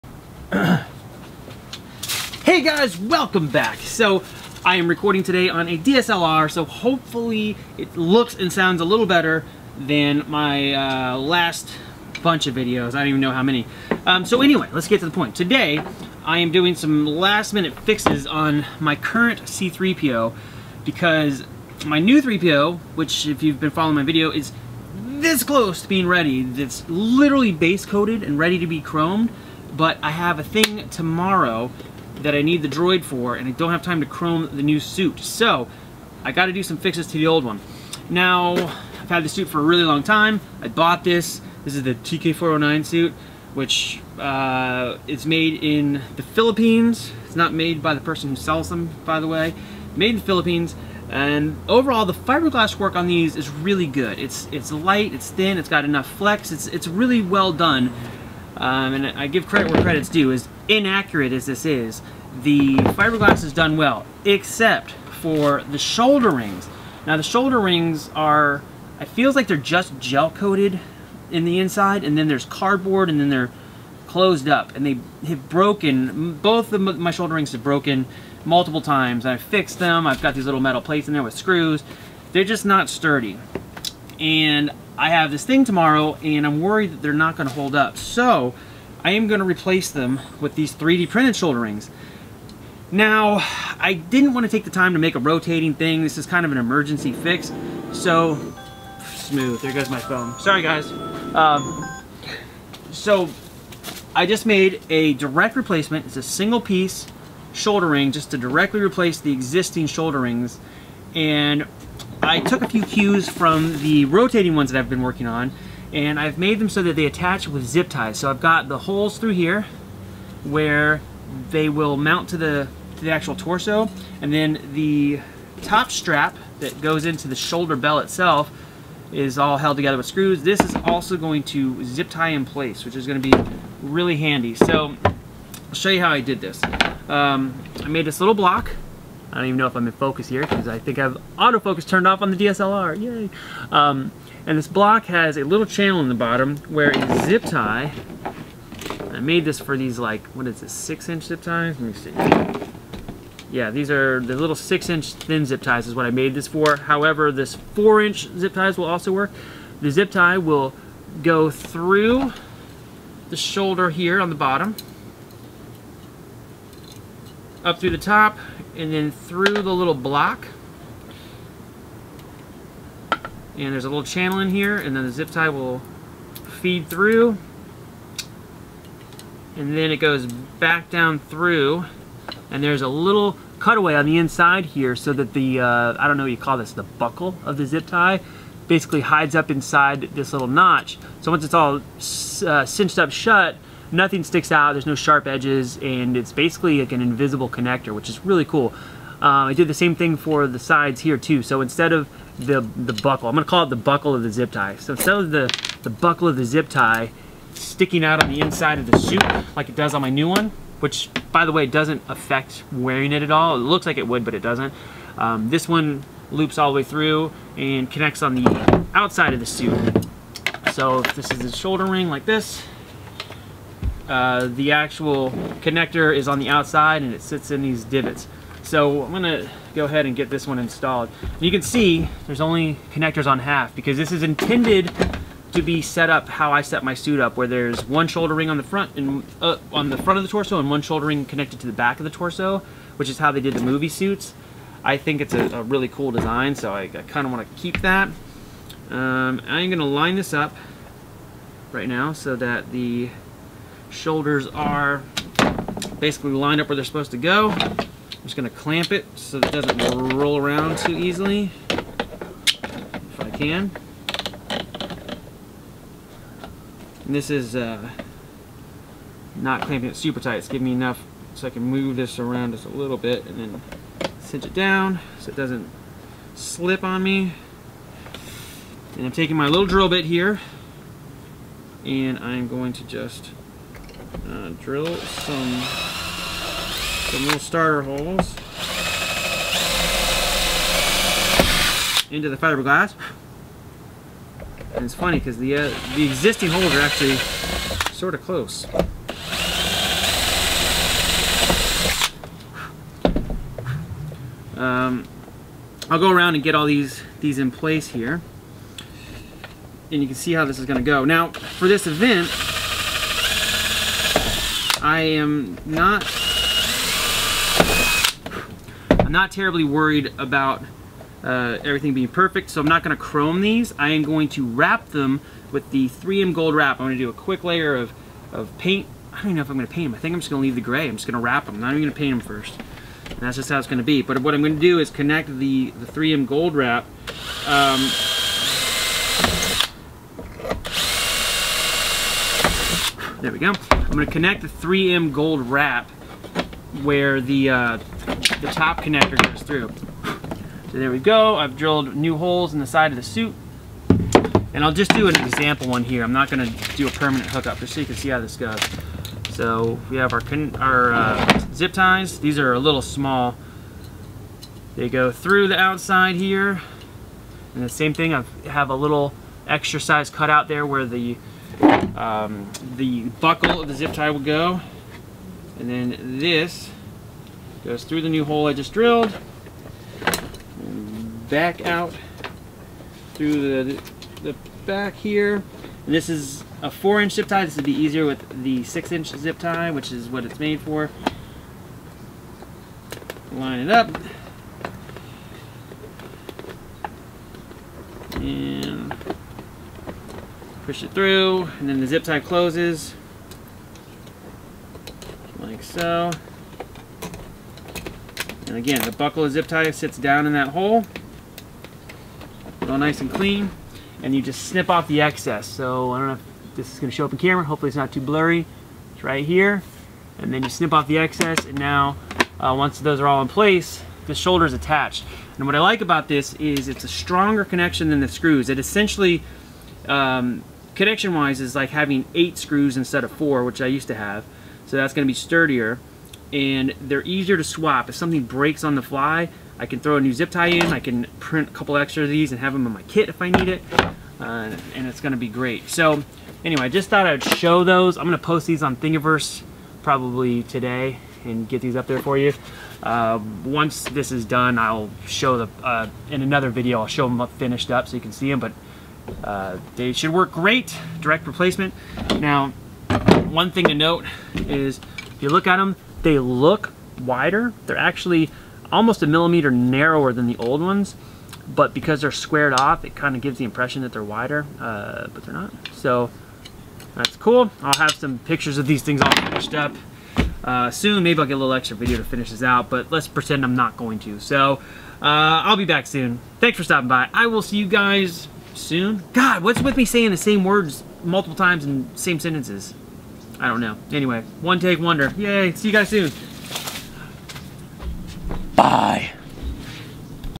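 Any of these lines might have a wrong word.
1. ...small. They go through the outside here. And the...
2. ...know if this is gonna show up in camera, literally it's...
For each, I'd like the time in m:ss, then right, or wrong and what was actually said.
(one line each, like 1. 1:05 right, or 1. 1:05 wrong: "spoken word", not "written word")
1. 6:02 right
2. 6:56 wrong: "hopefully", not "literally".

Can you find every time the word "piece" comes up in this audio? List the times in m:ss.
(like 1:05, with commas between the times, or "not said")
1:46.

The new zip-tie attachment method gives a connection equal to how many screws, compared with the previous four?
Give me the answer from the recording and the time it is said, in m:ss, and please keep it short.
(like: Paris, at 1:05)
8, at 7:12.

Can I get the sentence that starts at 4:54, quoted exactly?
And it's funny because the, uh, the existing holes are actually sort of close.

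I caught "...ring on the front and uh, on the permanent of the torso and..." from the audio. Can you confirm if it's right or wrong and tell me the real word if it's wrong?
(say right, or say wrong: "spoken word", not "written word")
wrong: "front", not "permanent".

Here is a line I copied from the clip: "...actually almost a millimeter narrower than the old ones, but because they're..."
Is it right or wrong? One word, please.
right.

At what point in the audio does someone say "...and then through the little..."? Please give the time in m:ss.
2:48.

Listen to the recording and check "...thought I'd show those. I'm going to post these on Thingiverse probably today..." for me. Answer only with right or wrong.
right.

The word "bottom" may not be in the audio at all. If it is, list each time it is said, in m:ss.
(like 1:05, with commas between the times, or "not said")
2:26, 2:44.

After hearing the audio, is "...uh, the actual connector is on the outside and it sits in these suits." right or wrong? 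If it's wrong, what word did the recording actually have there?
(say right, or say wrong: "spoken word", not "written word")
wrong: "divots", not "suits".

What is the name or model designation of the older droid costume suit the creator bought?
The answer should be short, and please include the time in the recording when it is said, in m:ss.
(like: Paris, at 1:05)
TK409, at 0:41.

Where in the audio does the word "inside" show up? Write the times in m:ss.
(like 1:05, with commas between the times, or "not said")
1:11, 3:04, 3:09, 3:28.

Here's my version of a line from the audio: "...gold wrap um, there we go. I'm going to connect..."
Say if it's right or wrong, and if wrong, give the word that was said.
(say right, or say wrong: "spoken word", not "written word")
right.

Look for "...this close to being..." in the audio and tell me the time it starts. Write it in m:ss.
0:24.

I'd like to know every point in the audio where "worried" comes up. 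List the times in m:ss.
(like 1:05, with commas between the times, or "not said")
1:26, 5:19.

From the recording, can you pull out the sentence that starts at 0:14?
Um, so anyway, let's get to the point.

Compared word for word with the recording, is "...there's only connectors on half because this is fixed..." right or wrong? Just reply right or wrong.
wrong.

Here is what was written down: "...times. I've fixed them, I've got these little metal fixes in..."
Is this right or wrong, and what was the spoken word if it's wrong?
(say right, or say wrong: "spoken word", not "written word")
wrong: "plates", not "fixes".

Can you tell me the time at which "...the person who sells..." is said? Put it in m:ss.
0:47.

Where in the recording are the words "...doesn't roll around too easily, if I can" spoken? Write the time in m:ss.
4:19.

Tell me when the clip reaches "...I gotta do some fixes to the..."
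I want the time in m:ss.
0:36.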